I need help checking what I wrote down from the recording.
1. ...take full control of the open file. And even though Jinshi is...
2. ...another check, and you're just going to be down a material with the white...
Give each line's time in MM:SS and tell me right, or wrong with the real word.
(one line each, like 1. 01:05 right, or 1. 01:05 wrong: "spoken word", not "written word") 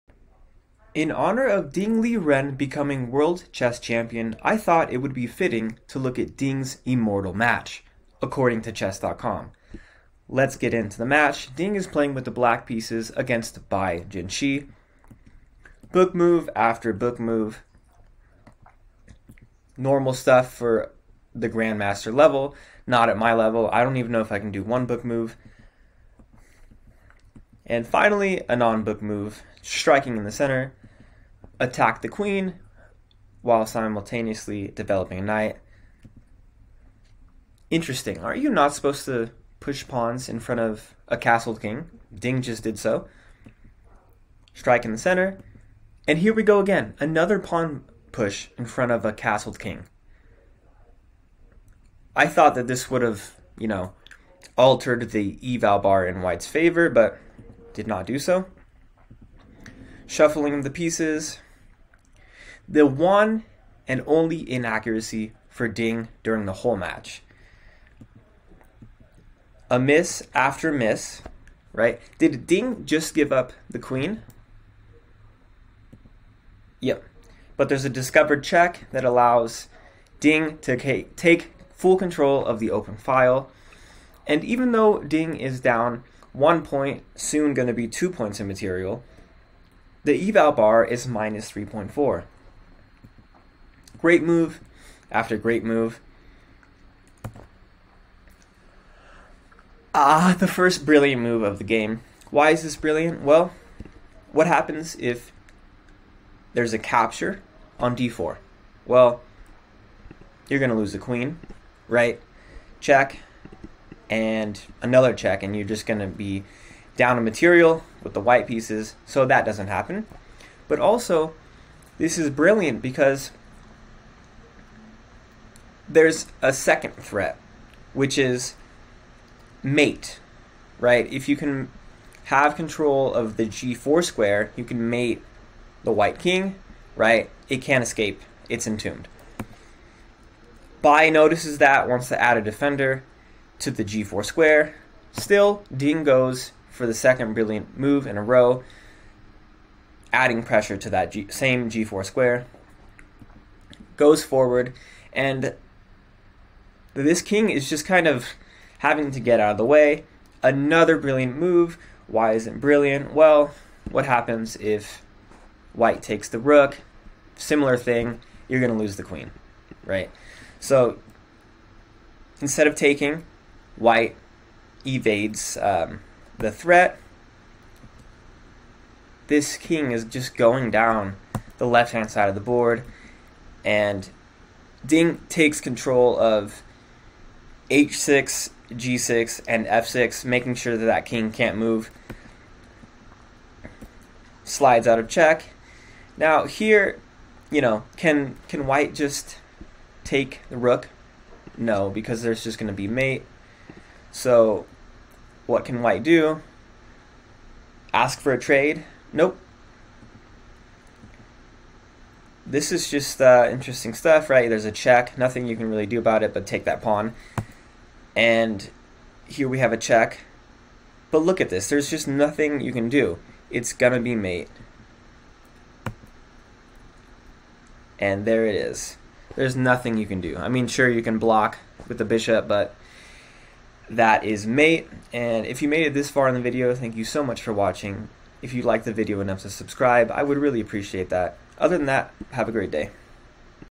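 1. 01:21 wrong: "Ding", not "Jinshi"
2. 01:54 right.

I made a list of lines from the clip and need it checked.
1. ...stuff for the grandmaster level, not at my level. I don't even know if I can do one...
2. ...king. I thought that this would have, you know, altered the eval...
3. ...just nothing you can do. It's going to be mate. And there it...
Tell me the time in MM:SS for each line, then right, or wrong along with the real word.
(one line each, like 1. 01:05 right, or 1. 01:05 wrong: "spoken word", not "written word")
1. 00:20 right
2. 00:49 right
3. 03:41 right.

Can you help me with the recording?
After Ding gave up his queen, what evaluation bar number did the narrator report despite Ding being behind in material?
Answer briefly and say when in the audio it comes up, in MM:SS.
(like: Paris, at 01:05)
-3.4, at 01:31.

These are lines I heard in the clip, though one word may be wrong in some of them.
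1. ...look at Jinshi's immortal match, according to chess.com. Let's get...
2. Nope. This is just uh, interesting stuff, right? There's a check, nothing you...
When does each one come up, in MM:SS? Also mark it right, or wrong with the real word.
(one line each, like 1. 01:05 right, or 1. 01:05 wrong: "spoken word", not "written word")
1. 00:05 wrong: "Ding", not "Jinshi"
2. 03:29 right.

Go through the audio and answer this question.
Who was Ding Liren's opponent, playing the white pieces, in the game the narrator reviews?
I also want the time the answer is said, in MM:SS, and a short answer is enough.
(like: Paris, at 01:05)
Bai Jinshi, at 00:13.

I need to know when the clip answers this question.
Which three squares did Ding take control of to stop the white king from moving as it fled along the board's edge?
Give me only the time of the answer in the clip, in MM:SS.
03:07.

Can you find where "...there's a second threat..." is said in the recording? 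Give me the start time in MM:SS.
02:05.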